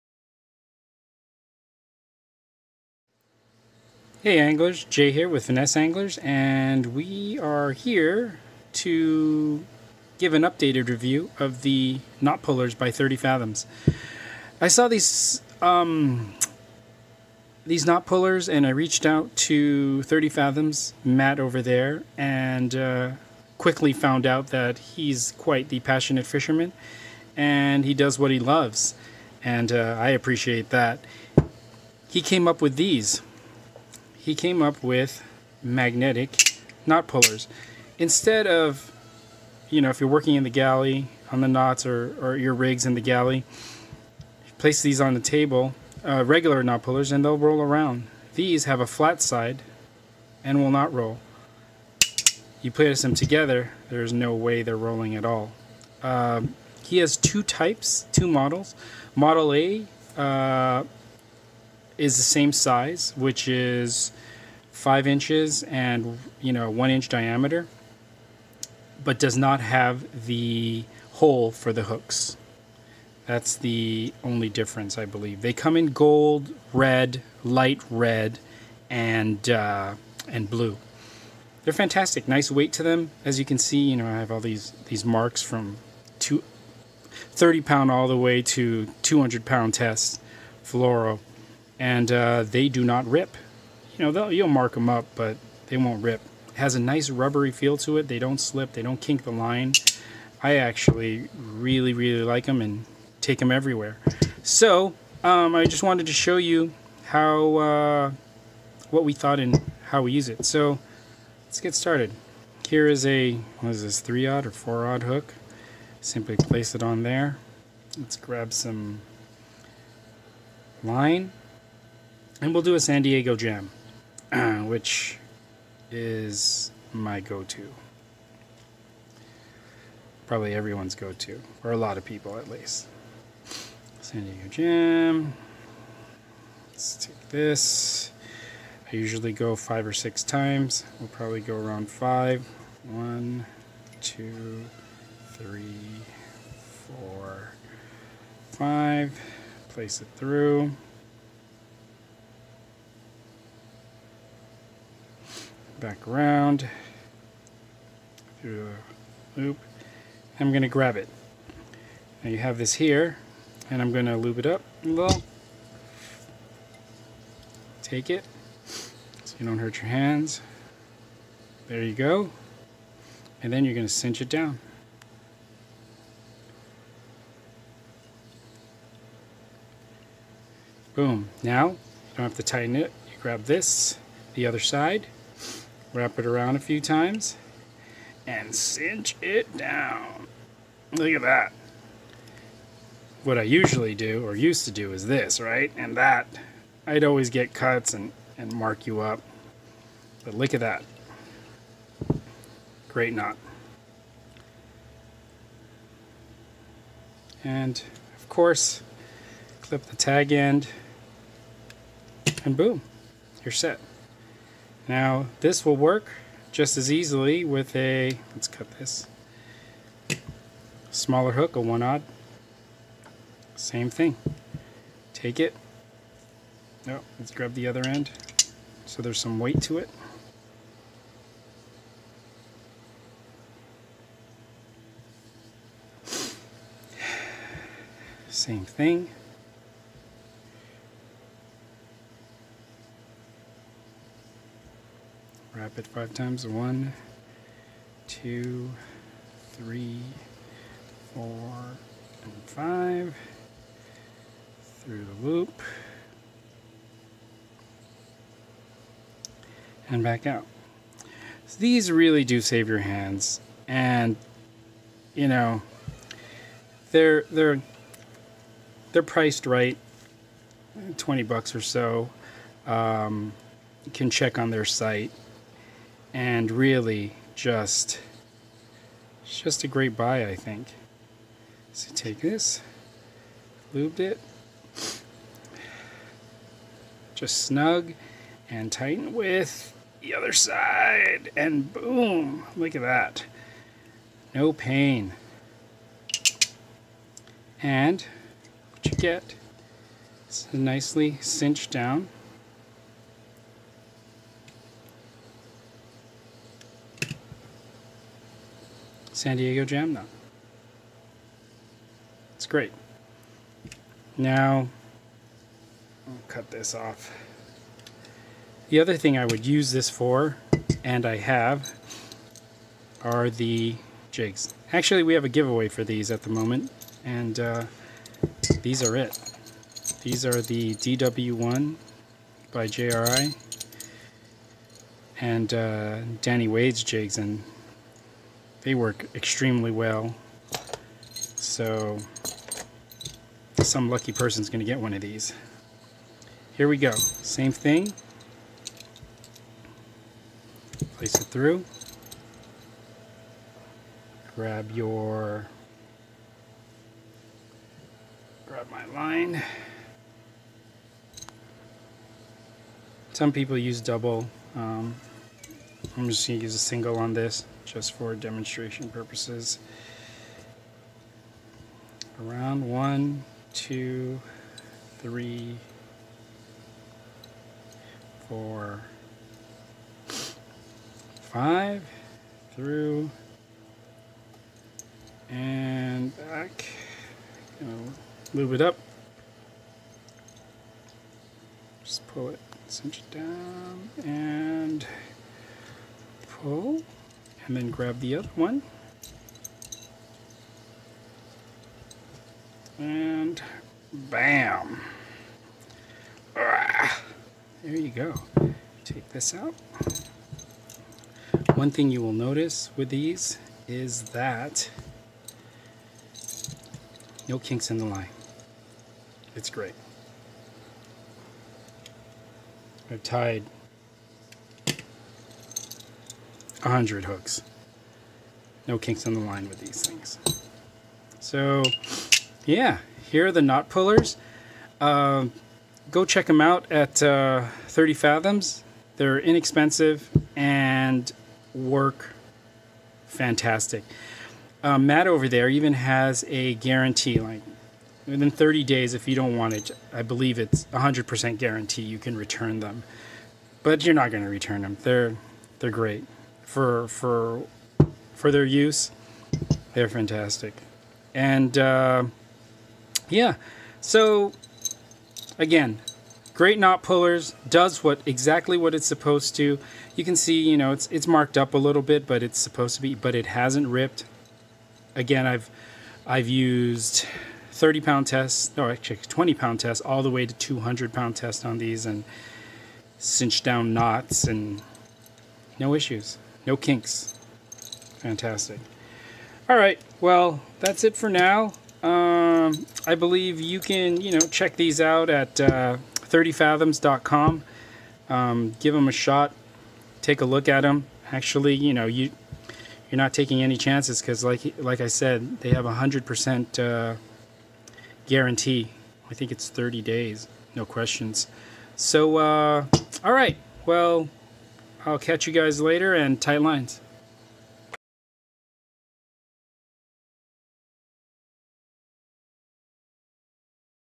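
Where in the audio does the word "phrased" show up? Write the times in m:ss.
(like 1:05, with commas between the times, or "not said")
not said.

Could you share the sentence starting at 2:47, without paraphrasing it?
Take it so you don't hurt your hands.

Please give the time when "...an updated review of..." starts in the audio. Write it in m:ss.
0:10.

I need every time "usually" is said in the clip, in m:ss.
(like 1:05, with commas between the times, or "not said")
2:18, 3:13.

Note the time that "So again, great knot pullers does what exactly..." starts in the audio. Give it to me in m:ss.
7:43.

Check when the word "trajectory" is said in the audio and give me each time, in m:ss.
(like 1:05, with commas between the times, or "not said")
not said.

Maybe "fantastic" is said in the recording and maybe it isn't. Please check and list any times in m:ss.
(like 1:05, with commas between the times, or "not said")
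1:21, 7:23, 7:39, 8:07.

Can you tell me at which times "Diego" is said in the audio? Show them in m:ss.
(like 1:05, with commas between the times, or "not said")
2:03, 2:14, 5:09.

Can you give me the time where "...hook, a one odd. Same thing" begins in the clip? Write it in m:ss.
3:41.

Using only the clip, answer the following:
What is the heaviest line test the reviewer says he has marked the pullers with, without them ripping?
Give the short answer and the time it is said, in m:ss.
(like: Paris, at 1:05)
200 pound, at 1:29.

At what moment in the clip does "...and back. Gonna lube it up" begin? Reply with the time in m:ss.
6:25.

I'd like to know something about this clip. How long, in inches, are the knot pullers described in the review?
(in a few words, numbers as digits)
5 inches.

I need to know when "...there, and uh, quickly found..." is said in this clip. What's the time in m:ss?
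0:21.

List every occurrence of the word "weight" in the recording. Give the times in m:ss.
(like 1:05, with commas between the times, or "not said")
1:22, 3:49.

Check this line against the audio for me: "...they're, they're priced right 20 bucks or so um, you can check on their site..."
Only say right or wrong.
right.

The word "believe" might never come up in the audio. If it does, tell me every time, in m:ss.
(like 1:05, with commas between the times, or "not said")
1:15, 7:30, 8:12.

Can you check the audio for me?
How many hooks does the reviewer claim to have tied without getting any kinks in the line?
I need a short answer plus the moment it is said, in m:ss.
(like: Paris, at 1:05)
100, at 7:06.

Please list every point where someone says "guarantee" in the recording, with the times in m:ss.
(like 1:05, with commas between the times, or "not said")
7:26, 7:31, 8:28.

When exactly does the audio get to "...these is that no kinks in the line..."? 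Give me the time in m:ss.
6:52.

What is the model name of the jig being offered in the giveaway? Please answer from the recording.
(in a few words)
DW1.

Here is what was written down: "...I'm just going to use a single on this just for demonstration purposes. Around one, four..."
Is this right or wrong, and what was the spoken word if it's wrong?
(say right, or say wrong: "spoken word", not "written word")
wrong: "two", not "four".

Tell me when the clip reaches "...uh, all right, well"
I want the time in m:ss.
8:32.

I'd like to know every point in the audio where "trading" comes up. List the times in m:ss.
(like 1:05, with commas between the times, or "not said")
not said.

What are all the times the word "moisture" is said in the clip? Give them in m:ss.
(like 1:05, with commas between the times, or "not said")
not said.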